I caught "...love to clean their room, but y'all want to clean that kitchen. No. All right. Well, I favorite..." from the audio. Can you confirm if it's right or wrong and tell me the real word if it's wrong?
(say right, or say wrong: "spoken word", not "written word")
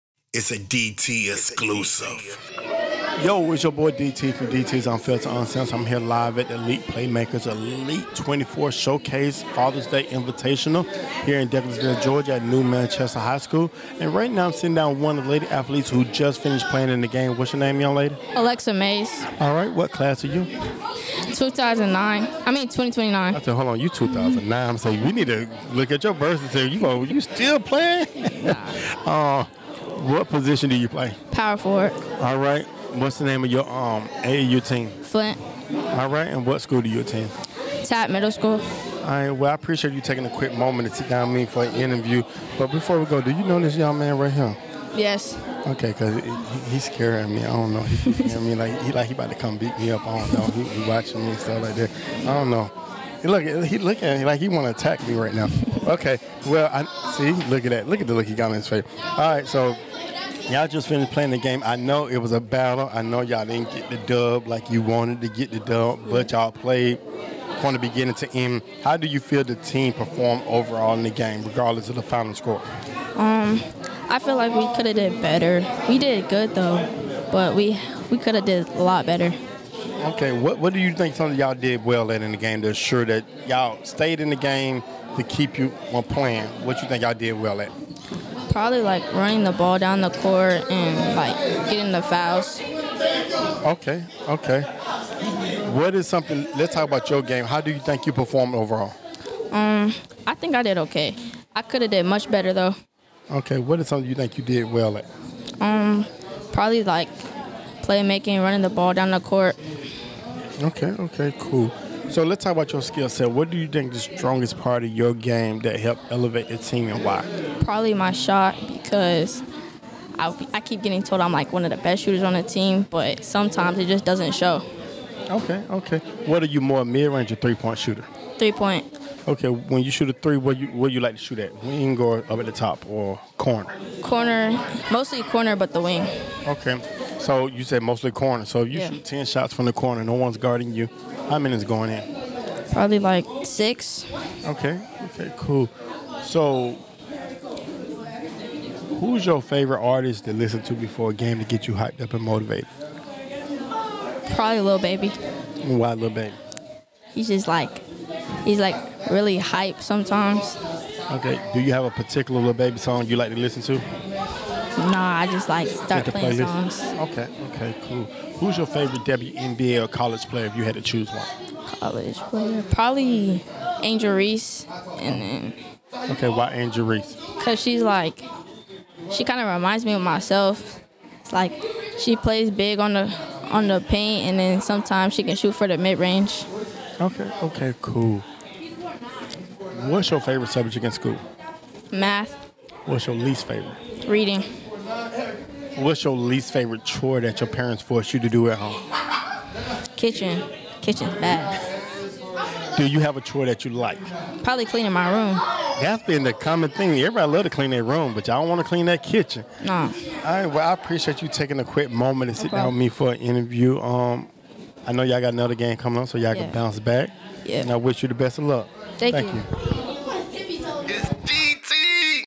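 wrong: "appreciate", not "favorite".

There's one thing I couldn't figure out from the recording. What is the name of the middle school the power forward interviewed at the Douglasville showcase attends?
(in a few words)
Tapp Middle School.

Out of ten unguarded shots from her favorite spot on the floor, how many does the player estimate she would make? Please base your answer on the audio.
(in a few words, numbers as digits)
6.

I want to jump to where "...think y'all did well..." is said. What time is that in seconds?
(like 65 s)
86 s.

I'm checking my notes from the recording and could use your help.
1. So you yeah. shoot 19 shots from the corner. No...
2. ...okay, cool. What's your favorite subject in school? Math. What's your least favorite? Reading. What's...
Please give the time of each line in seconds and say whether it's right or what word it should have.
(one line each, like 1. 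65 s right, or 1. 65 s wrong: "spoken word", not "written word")
1. 138 s wrong: "10", not "19"
2. 187 s right.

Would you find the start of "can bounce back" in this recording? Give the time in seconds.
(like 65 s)
216 s.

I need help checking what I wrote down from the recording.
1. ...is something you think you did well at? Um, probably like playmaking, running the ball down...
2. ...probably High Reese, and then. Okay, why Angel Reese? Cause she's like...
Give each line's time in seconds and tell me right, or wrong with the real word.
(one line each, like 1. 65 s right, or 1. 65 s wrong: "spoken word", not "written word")
1. 103 s right
2. 172 s wrong: "Angel", not "High".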